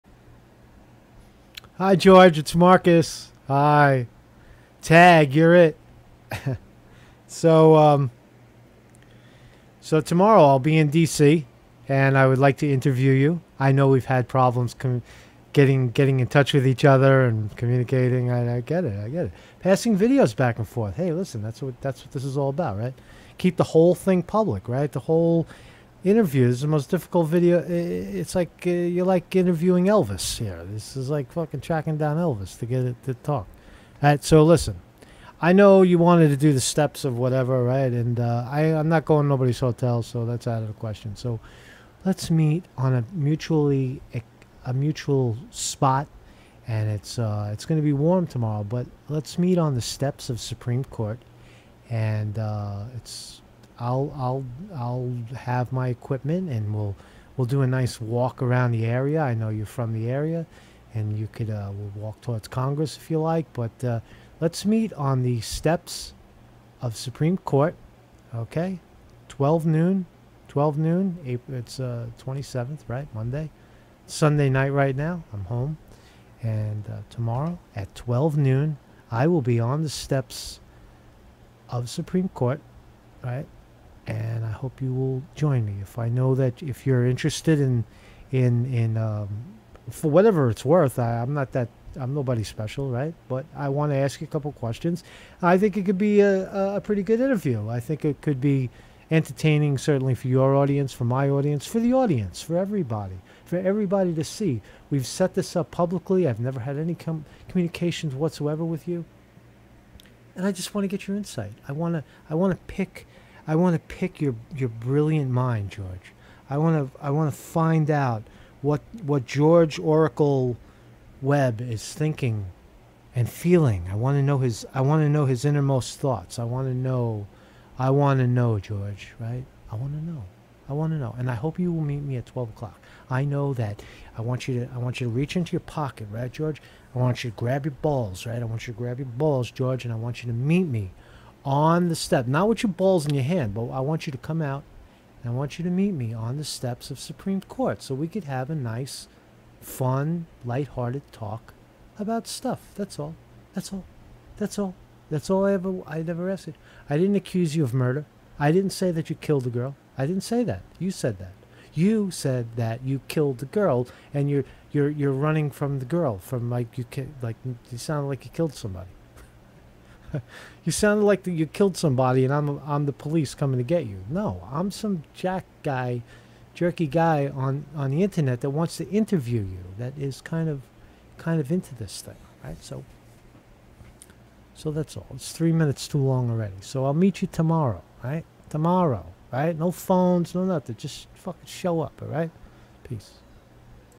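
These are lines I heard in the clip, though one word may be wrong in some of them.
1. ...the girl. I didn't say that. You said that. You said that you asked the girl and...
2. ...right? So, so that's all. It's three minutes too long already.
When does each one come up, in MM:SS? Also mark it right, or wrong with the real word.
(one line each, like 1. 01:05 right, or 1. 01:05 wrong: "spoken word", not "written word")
1. 02:39 wrong: "killed", not "asked"
2. 03:02 right.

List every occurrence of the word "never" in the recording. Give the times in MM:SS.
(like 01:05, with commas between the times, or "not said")
01:46, 02:36.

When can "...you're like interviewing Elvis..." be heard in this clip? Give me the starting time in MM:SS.
00:28.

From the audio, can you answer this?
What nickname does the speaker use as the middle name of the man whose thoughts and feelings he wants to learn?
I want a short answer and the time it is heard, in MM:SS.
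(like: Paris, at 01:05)
Oracle, at 01:59.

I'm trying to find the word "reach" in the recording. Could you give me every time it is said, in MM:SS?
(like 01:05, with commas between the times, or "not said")
02:15.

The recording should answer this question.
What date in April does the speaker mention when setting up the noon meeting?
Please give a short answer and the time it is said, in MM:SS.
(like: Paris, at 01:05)
April 27, at 01:12.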